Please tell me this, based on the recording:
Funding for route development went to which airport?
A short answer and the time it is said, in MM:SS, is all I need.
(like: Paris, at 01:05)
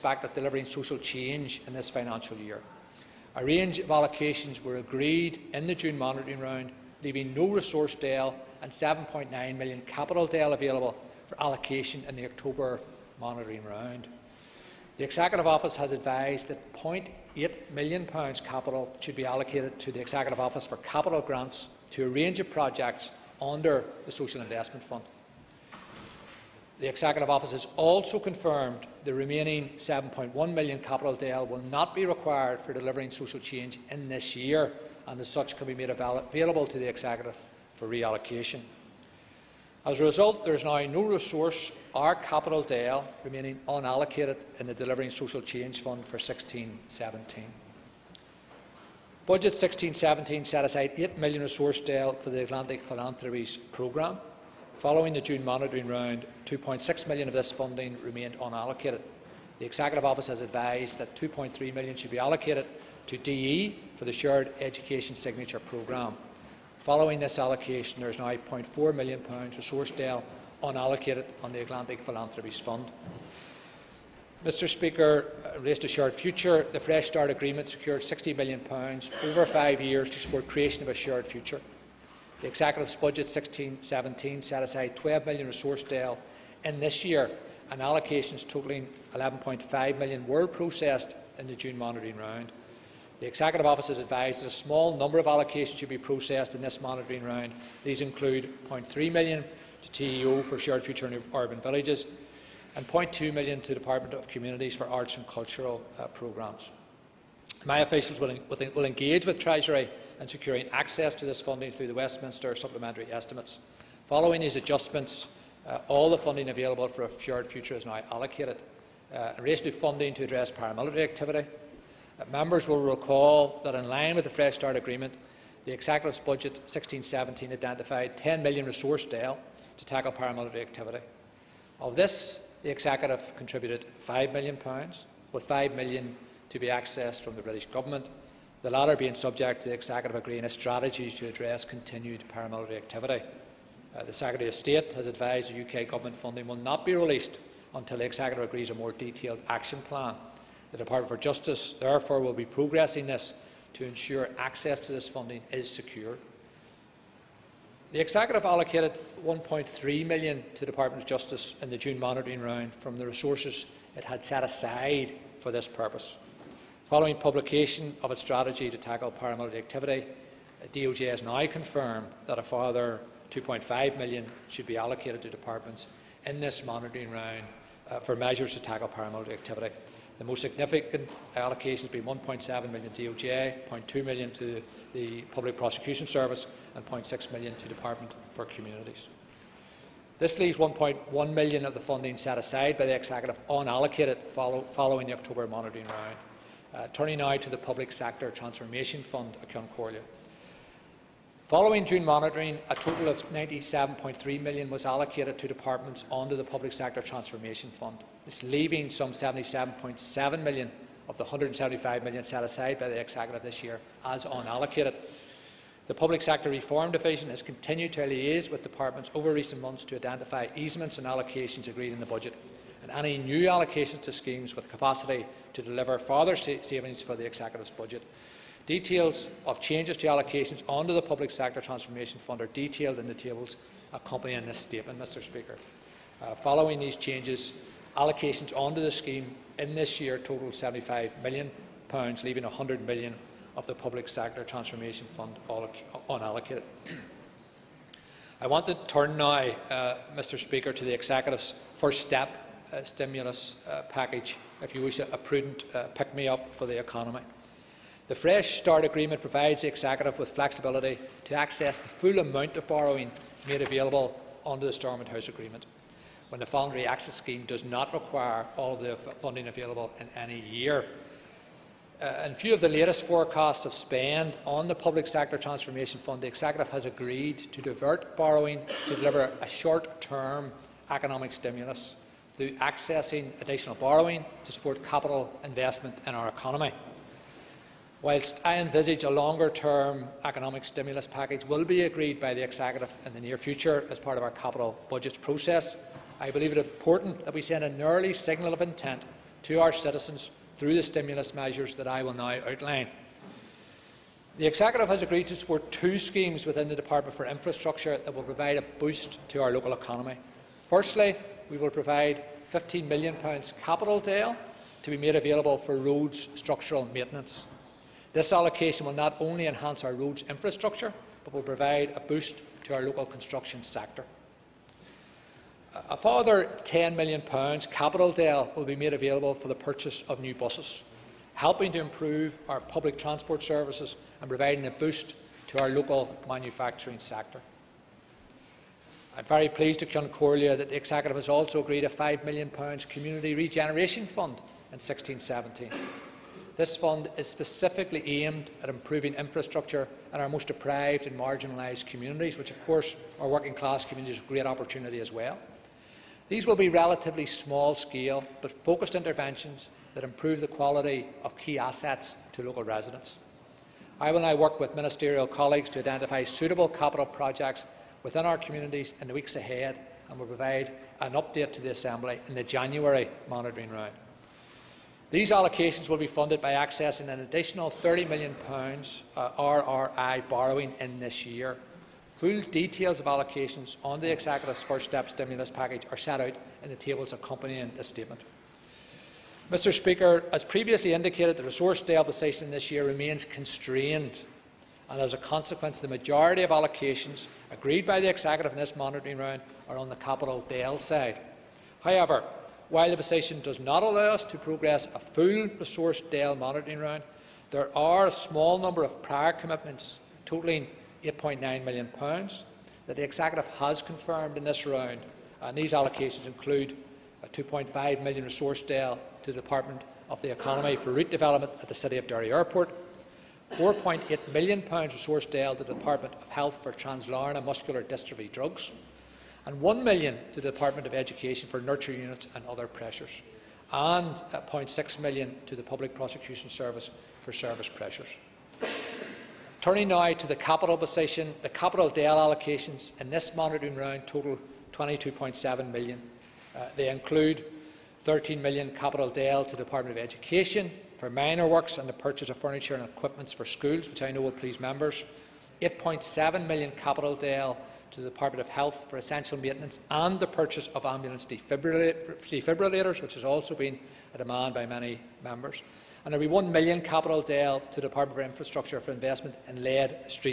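City of Derry Airport, at 07:01.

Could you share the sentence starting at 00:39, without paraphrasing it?
As a result, there is now no resource or capital DL remaining unallocated in the Delivering Social Change Fund for 16-17.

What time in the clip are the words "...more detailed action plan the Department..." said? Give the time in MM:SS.
02:28.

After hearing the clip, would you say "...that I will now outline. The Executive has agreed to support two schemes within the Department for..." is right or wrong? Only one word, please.
right.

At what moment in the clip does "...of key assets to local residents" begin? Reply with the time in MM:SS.
06:01.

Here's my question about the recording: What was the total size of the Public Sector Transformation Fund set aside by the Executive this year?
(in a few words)
175 million.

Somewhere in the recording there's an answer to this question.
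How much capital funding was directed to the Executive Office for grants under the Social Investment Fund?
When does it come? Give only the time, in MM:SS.
00:16.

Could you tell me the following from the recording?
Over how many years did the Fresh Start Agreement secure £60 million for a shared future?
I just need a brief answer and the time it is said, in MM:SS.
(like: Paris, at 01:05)
5, at 01:19.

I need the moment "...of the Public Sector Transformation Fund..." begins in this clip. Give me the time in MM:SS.
04:03.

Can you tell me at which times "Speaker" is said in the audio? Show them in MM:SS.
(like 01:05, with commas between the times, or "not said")
01:14, 03:55, 04:10, 06:29.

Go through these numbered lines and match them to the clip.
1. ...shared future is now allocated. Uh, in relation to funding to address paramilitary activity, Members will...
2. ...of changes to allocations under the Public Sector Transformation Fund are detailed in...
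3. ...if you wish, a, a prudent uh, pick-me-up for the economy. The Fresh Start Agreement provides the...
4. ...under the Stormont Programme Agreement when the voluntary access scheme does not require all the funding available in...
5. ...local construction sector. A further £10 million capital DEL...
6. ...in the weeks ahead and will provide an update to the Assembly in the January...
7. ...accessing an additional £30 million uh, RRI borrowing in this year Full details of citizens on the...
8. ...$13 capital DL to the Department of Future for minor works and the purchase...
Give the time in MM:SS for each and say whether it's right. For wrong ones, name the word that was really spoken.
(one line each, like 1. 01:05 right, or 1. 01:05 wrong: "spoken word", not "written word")
1. 01:57 right
2. 03:49 right
3. 04:14 right
4. 04:24 wrong: "House", not "Programme"
5. 05:22 right
6. 06:09 right
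7. 06:16 wrong: "allocations", not "citizens"
8. 07:28 wrong: "Education", not "Future".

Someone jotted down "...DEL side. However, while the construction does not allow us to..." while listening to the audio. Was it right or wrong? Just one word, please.
wrong.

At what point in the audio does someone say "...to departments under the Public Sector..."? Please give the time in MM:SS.
03:25.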